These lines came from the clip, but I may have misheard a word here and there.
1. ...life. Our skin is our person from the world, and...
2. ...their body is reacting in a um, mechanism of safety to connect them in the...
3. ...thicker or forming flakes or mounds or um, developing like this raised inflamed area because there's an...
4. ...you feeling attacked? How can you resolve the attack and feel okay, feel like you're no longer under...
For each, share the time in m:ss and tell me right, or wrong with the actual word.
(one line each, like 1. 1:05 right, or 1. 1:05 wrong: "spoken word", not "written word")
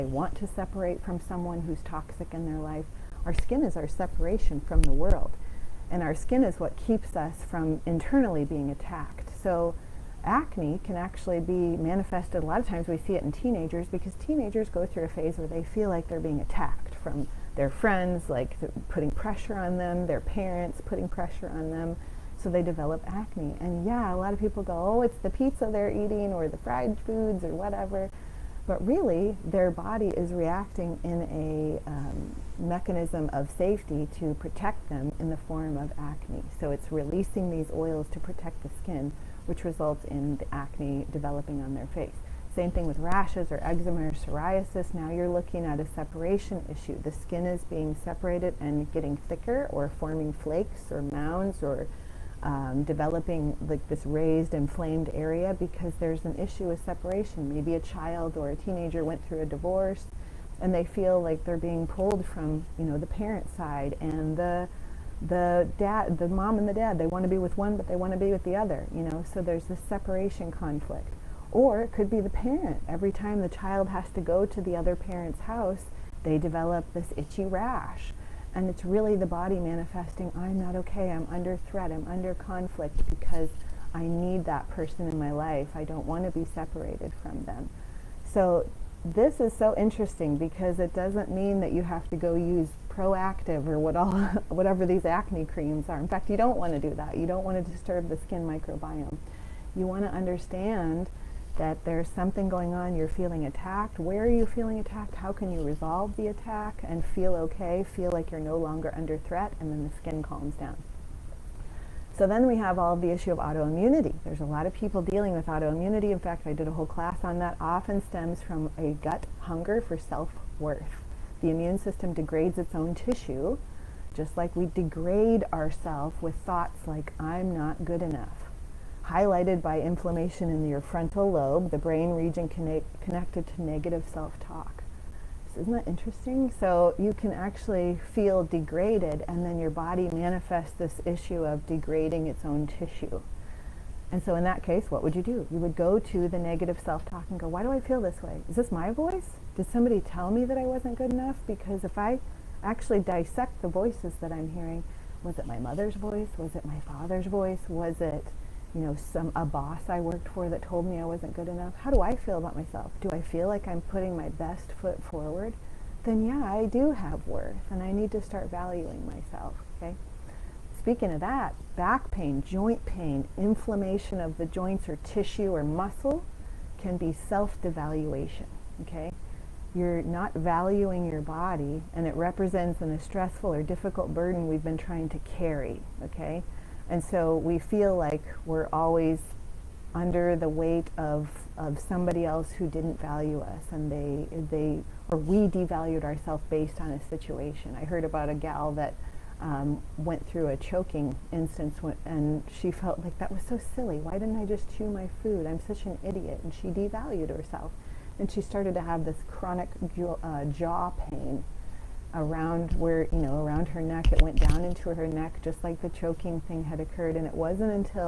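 1. 0:02 wrong: "separation", not "person"
2. 0:29 wrong: "protect", not "connect"
3. 0:49 right
4. 1:44 right.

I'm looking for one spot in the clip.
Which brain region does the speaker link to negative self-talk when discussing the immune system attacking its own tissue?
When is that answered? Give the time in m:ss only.
2:10.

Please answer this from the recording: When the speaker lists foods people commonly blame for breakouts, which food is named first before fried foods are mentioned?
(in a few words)
Pizza.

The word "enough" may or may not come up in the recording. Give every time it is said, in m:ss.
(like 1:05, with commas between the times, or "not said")
2:08, 2:31, 2:41.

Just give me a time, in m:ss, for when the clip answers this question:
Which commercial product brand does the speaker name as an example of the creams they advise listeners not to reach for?
1:32.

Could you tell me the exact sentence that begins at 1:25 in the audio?
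I don't want to be separated from them.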